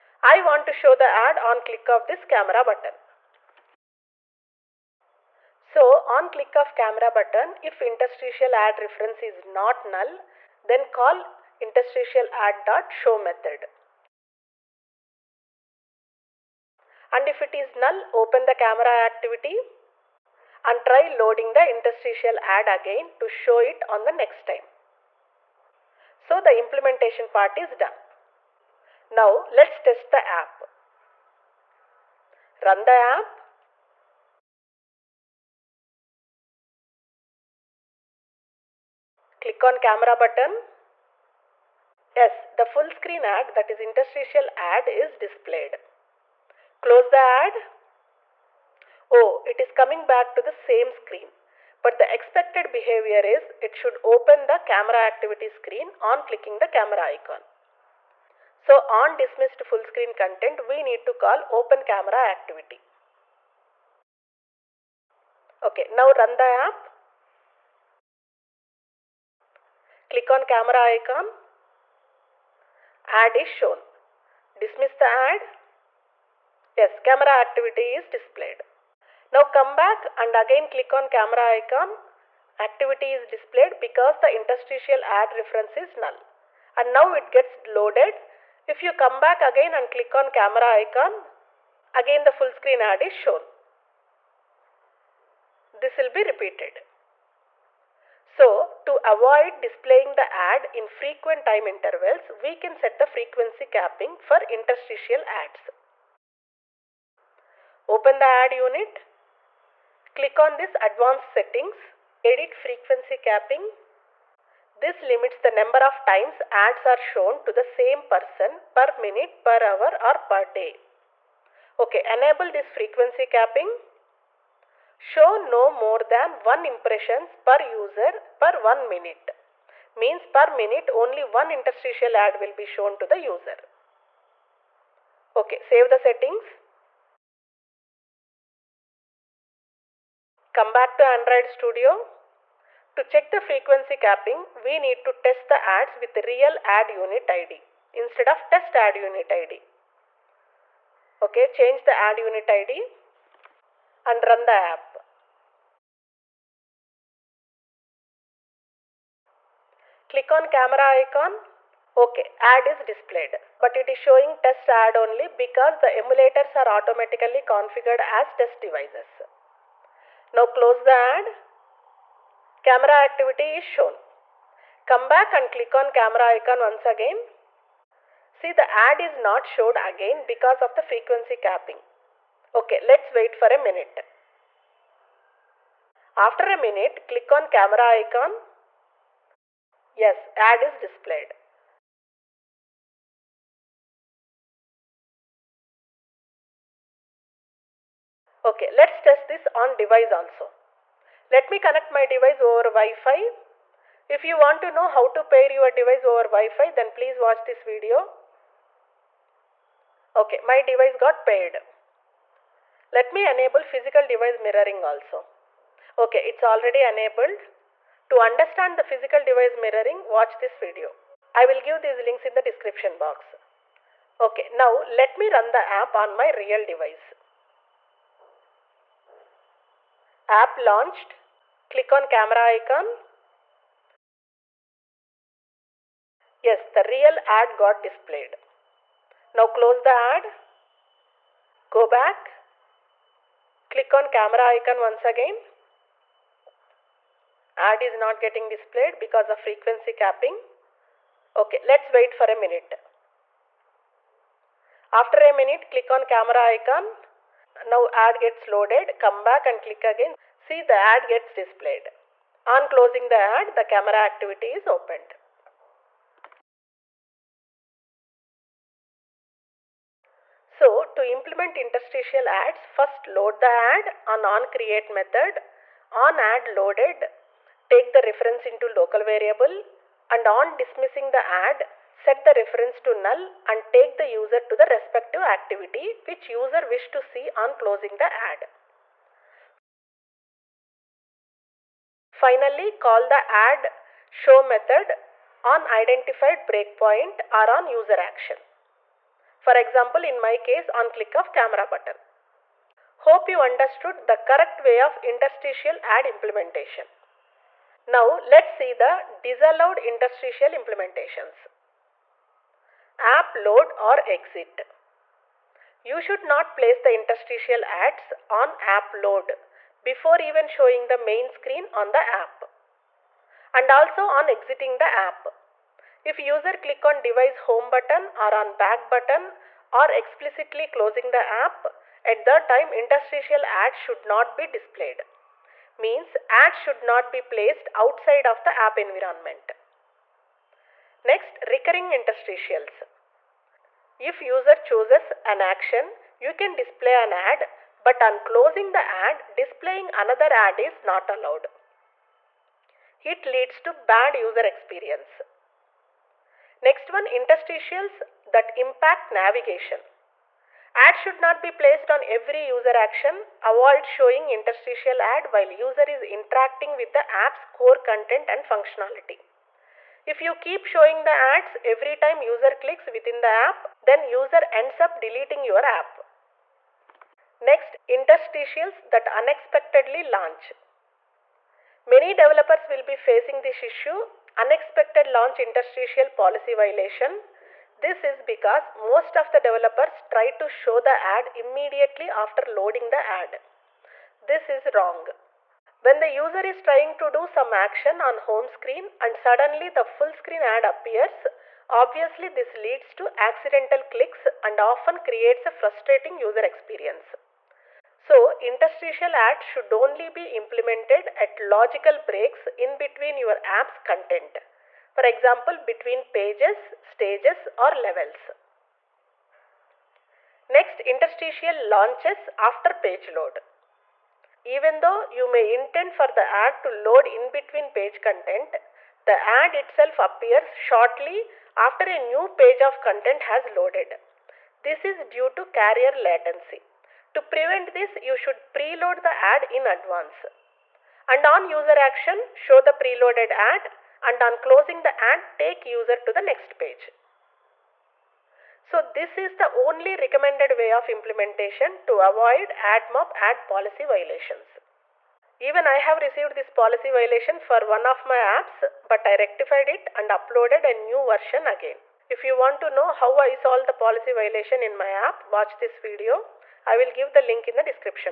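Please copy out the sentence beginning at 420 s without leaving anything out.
Next, interstitial launches after page load.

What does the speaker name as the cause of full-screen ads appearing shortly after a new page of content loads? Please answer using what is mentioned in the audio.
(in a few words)
Carrier latency.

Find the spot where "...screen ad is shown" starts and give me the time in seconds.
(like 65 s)
92 s.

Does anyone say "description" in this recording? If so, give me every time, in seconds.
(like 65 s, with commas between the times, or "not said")
222 s.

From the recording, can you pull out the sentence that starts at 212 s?
Let me enable physical device mirroring also.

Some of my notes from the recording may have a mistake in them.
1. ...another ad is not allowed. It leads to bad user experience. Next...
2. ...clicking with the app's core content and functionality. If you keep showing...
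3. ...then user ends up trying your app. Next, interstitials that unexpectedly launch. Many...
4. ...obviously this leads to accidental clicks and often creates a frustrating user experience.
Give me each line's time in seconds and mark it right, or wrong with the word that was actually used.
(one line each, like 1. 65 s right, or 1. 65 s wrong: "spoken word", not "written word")
1. 349 s right
2. 366 s wrong: "interacting", not "clicking"
3. 373 s wrong: "deleting", not "trying"
4. 401 s right.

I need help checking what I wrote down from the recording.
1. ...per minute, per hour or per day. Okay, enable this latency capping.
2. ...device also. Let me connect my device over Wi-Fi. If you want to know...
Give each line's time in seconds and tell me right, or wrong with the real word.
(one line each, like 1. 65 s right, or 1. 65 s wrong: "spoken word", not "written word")
1. 118 s wrong: "frequency", not "latency"
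2. 199 s right.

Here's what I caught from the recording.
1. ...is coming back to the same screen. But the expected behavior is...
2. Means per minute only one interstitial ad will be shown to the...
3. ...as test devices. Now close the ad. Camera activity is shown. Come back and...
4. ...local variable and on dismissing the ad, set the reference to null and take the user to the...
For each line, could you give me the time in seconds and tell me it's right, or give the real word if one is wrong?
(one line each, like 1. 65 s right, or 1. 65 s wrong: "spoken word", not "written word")
1. 49 s right
2. 130 s right
3. 168 s right
4. 278 s right.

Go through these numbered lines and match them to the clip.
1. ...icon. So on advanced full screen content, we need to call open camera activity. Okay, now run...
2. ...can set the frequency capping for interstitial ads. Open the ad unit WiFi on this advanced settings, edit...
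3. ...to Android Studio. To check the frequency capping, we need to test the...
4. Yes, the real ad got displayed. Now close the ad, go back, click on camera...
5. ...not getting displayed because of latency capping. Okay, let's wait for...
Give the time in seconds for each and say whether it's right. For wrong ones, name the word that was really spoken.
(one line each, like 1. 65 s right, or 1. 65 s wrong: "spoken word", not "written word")
1. 57 s wrong: "dismissed", not "advanced"
2. 102 s wrong: "Click", not "WiFi"
3. 140 s right
4. 236 s right
5. 247 s wrong: "frequency", not "latency".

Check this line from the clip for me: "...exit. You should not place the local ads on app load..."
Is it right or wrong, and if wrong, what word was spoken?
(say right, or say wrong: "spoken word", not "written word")
wrong: "interstitial", not "local".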